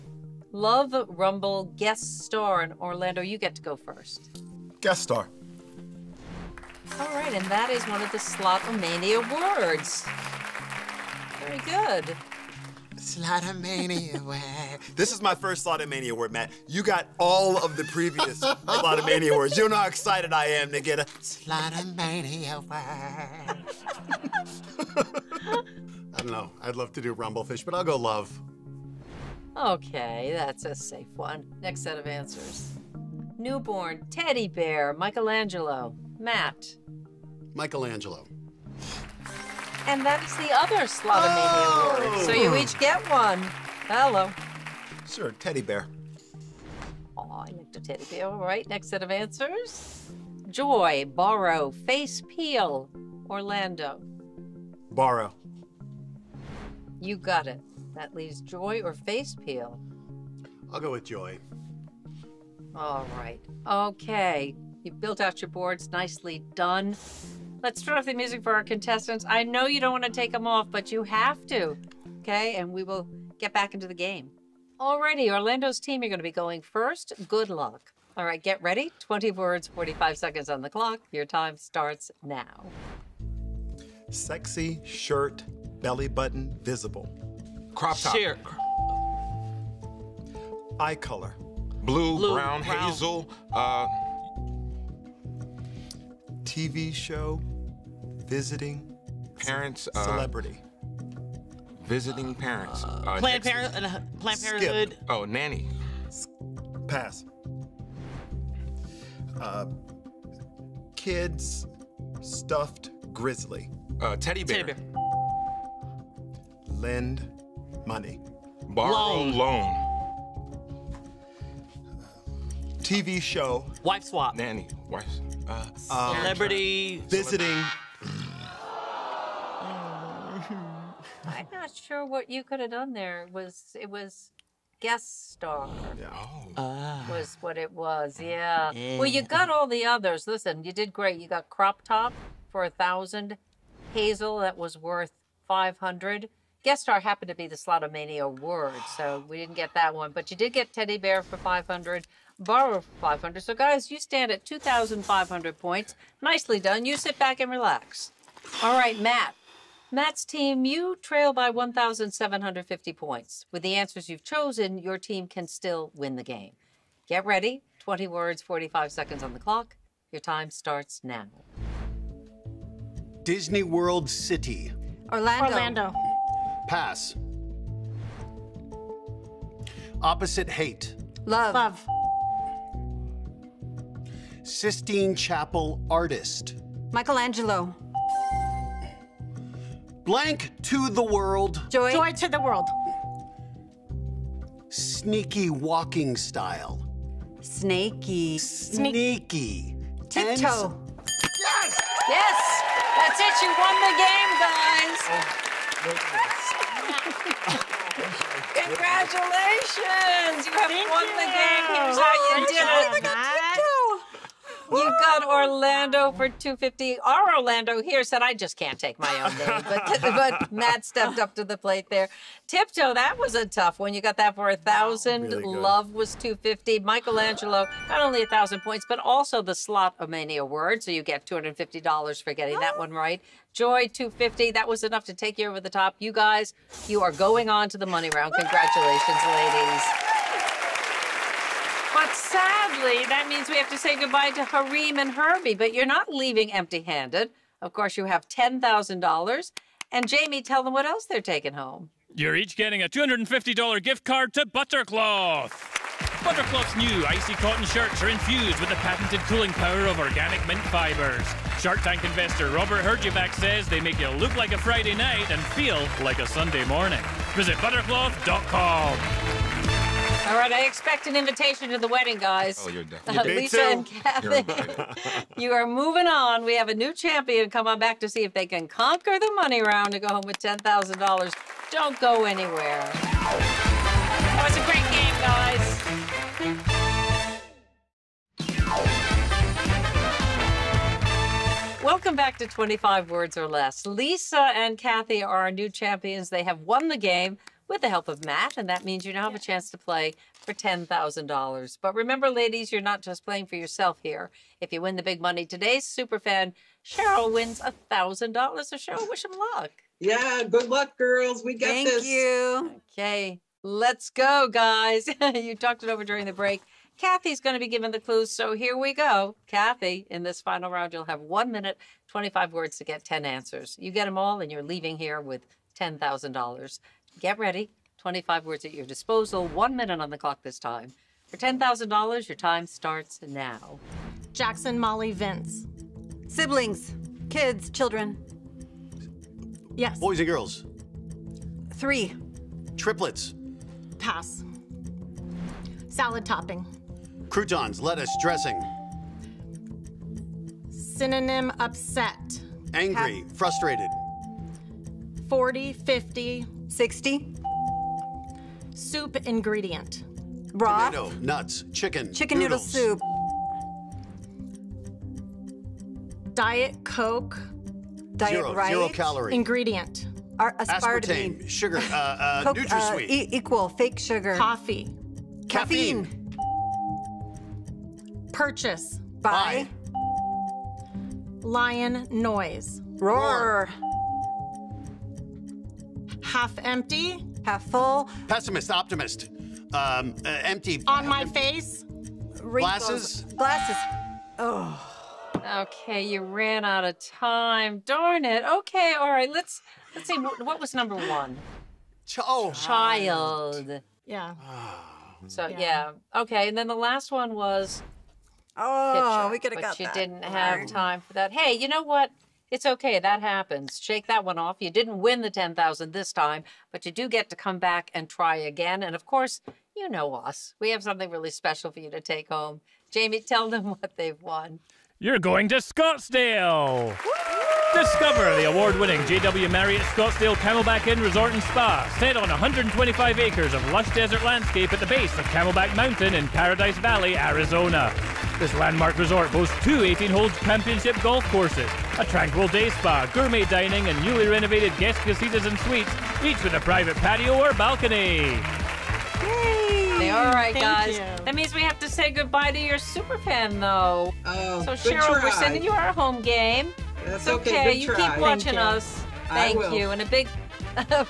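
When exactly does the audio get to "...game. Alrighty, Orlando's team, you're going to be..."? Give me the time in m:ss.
1:13.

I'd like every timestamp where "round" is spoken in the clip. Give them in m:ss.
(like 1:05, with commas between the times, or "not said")
3:58, 4:39, 5:20.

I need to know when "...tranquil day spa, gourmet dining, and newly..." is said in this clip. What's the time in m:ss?
7:22.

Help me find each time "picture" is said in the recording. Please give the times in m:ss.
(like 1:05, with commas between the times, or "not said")
6:48.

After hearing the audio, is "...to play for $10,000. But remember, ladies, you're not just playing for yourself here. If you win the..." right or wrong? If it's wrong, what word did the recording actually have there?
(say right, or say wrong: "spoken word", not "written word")
right.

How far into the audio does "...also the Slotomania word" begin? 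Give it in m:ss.
3:48.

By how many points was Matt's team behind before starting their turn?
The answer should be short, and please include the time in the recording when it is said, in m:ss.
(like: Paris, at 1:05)
1,750, at 2:41.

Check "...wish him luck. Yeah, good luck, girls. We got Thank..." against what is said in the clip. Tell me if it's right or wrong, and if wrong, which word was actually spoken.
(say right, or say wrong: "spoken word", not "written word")
right.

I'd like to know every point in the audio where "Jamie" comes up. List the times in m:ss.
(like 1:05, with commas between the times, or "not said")
4:10, 7:02.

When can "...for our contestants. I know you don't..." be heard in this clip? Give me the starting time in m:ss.
1:08.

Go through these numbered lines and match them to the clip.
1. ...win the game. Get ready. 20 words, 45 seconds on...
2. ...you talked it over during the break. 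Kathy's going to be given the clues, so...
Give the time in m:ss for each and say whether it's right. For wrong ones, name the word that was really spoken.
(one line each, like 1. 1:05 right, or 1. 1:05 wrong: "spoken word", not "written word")
1. 2:45 right
2. 5:15 right.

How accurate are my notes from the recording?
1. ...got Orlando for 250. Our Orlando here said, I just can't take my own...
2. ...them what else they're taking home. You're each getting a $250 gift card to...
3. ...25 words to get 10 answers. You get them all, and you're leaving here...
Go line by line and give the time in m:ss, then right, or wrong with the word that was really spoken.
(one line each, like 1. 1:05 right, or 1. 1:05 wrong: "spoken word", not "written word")
1. 3:34 right
2. 4:10 right
3. 5:22 right.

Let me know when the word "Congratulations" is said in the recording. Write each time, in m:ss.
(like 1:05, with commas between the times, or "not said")
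3:28, 3:58.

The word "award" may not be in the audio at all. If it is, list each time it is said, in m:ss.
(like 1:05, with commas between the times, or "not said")
0:42, 7:08.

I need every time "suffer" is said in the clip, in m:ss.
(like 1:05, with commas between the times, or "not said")
not said.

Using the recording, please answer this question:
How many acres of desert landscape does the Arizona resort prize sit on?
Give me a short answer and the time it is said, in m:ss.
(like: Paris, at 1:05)
125, at 7:12.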